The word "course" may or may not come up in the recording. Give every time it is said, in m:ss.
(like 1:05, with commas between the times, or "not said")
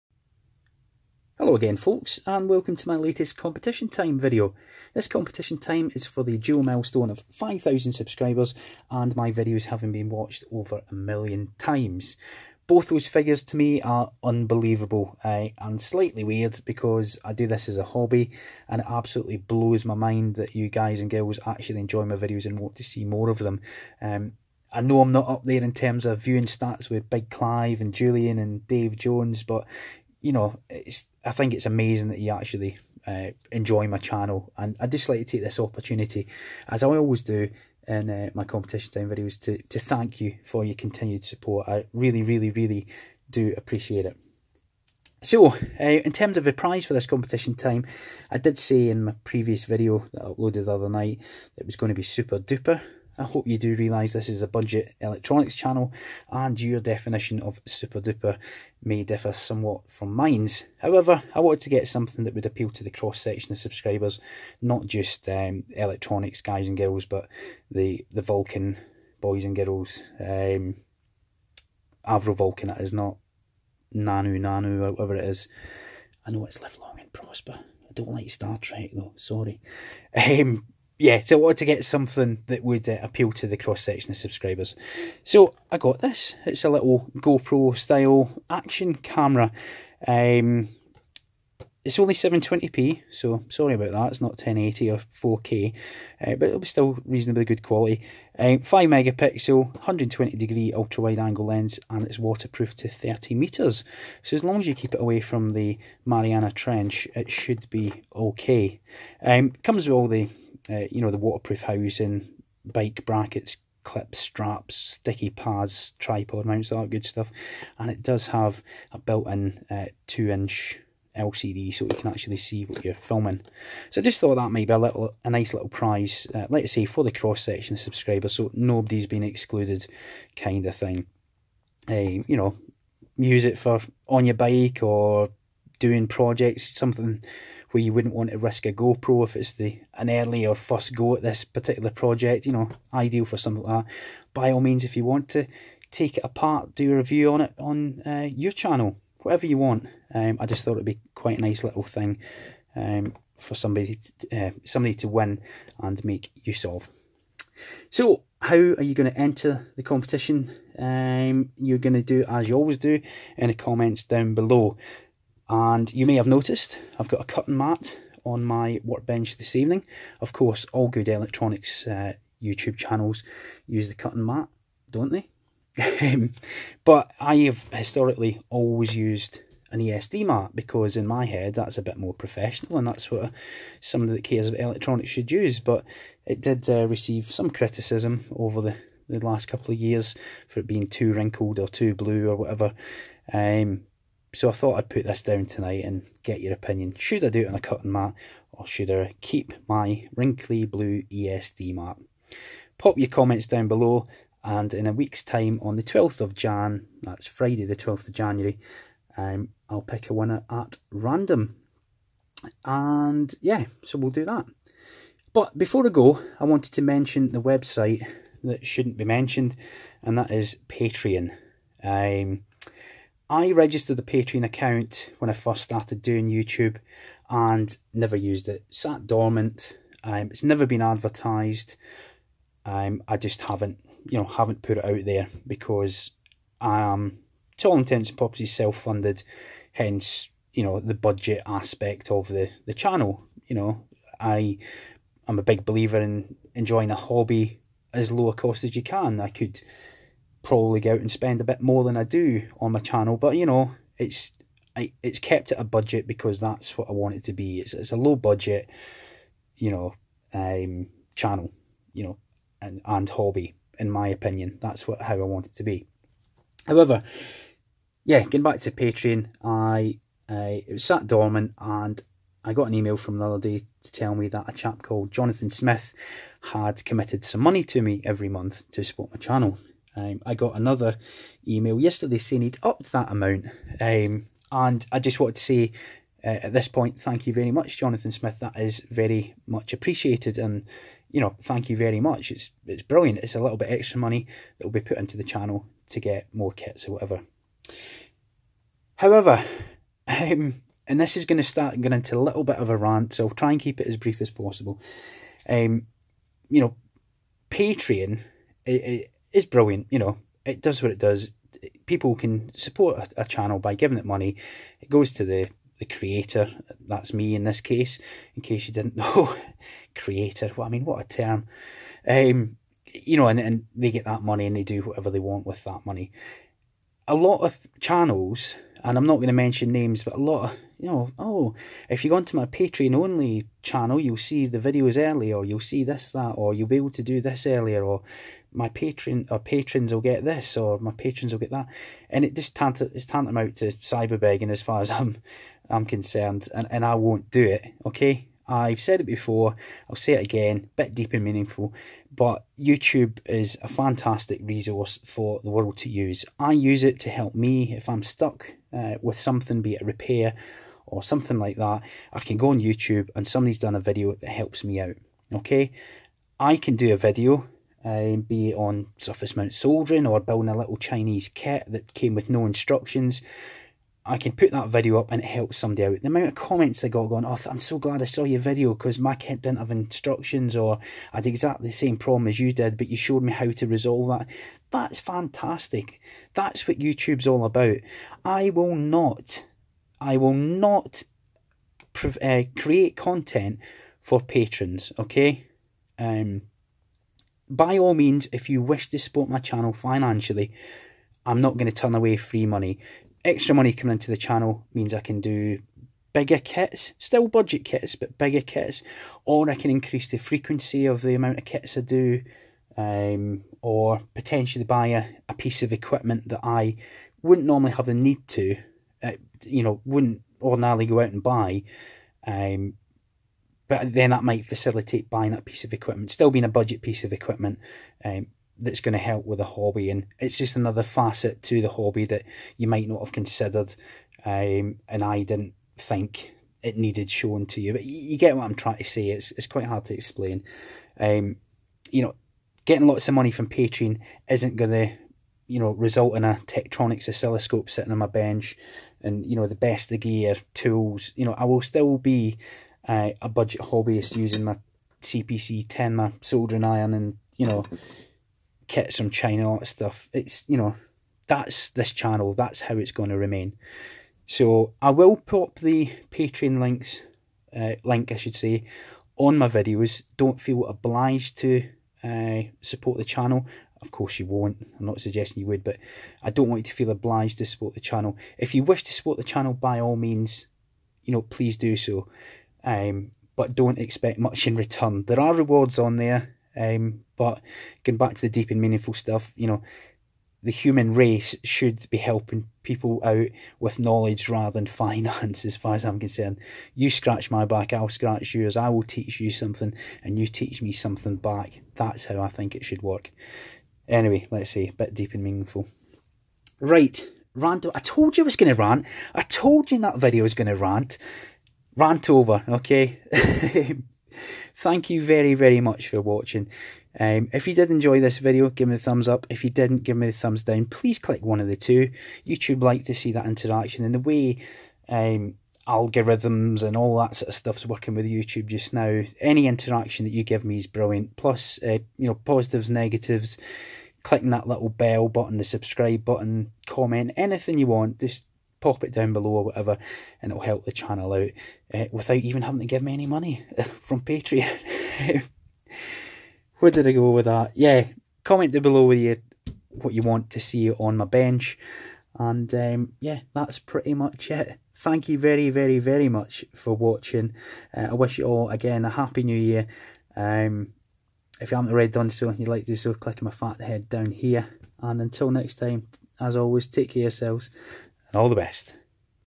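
2:50, 7:53.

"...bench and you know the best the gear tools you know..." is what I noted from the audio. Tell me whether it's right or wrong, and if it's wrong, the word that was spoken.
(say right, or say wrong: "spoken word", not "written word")
right.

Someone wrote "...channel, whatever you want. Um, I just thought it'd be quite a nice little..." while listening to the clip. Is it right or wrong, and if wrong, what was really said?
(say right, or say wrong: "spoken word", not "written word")
right.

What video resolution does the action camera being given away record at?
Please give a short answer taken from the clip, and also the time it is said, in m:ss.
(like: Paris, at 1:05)
720p, at 1:32.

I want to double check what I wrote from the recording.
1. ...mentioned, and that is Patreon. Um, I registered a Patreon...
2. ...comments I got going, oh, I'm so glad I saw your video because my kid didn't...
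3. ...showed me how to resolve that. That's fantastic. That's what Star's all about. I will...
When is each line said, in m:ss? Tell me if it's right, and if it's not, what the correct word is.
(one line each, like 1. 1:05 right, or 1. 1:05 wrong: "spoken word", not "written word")
1. 3:39 right
2. 6:16 right
3. 6:22 wrong: "YouTube", not "Star".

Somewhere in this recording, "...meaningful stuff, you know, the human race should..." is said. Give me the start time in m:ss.
8:08.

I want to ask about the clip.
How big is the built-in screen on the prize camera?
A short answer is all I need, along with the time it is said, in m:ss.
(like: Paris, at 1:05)
two-inch, at 2:00.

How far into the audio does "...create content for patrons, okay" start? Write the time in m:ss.
6:32.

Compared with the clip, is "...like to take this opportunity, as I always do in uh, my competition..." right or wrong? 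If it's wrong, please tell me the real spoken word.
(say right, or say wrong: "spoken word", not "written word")
right.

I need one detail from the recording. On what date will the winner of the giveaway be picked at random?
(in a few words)
Friday 12th January.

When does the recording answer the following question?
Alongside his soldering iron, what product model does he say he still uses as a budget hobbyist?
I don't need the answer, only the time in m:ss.
7:35.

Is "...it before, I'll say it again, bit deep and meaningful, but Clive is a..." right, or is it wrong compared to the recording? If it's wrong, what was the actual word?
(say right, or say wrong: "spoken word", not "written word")
wrong: "YouTube", not "Clive".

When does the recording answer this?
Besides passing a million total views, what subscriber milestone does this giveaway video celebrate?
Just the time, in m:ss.
0:07.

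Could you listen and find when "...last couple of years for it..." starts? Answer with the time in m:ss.
3:09.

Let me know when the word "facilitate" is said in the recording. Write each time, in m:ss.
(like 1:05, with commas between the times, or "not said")
7:04.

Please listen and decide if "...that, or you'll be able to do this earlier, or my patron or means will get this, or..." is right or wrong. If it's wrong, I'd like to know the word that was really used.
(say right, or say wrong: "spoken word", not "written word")
wrong: "patrons", not "means".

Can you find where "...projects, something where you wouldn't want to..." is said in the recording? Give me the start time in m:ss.
2:16.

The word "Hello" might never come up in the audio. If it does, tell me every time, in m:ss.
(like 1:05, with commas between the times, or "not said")
0:01.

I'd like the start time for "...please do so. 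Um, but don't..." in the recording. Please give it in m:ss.
8:01.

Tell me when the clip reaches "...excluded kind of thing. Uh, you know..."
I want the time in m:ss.
2:09.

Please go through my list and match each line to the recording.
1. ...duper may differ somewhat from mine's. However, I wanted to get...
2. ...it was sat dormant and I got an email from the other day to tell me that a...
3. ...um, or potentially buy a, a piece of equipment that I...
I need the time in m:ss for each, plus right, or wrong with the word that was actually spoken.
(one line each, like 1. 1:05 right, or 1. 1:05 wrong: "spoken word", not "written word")
1. 0:58 right
2. 4:30 right
3. 6:52 right.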